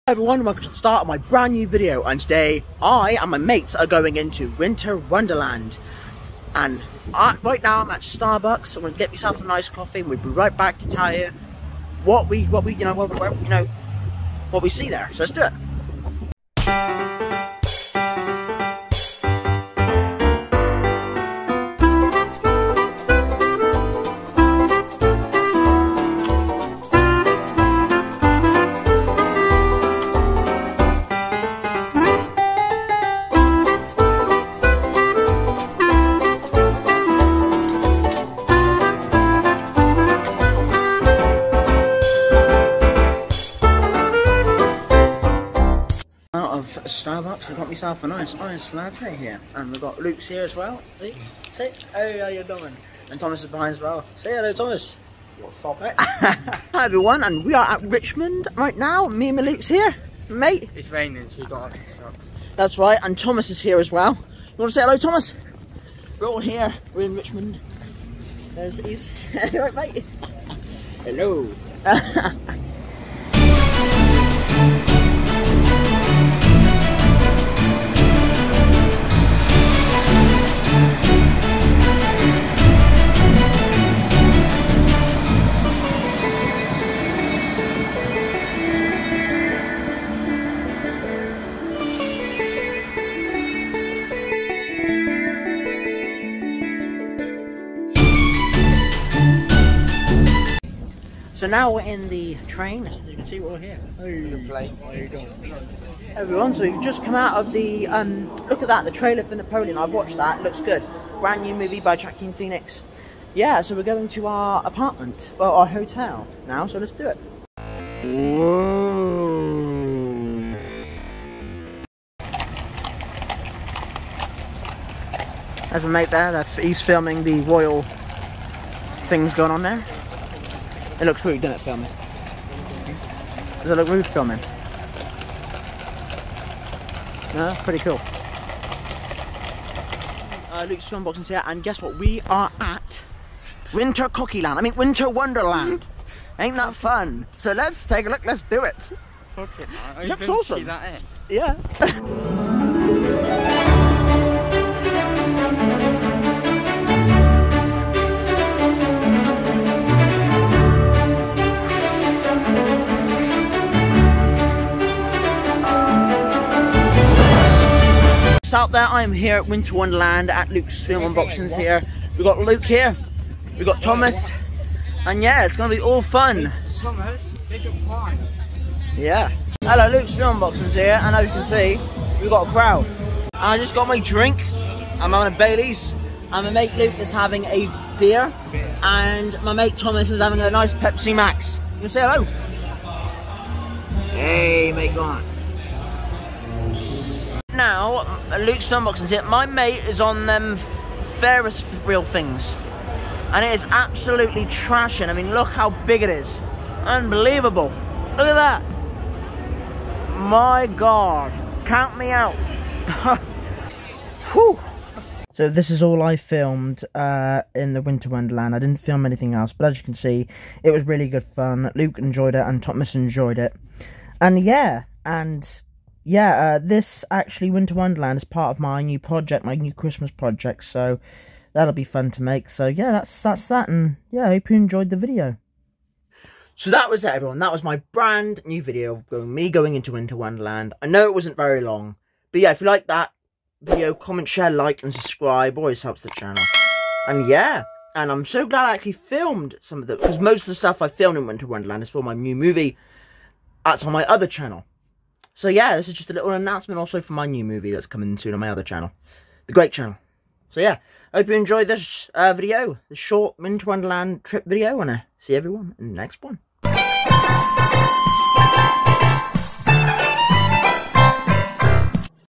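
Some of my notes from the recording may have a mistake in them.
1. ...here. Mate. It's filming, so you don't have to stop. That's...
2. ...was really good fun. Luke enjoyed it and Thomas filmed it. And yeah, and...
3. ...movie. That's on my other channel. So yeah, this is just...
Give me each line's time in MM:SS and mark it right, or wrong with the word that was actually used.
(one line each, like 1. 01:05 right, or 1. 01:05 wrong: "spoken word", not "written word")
1. 00:59 wrong: "raining", not "filming"
2. 03:40 wrong: "enjoyed", not "filmed"
3. 04:12 right.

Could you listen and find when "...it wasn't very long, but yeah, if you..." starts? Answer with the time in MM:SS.
04:01.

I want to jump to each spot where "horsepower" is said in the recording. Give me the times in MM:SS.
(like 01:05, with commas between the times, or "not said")
not said.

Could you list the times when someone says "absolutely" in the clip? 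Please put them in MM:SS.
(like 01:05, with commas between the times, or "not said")
03:23.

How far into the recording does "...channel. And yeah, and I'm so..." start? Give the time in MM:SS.
04:06.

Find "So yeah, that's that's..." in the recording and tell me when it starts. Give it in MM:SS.
03:52.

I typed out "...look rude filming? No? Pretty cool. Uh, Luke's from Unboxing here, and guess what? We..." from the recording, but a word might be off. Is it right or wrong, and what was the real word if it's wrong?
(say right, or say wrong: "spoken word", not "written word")
right.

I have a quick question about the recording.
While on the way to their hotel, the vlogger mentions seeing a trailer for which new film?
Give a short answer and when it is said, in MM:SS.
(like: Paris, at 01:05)
Napoleon, at 01:49.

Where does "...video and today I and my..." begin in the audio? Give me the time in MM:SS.
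00:01.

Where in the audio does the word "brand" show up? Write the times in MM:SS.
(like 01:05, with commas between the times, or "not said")
00:01, 01:51, 03:57.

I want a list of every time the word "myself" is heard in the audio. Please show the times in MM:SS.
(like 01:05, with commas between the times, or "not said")
00:09, 00:47.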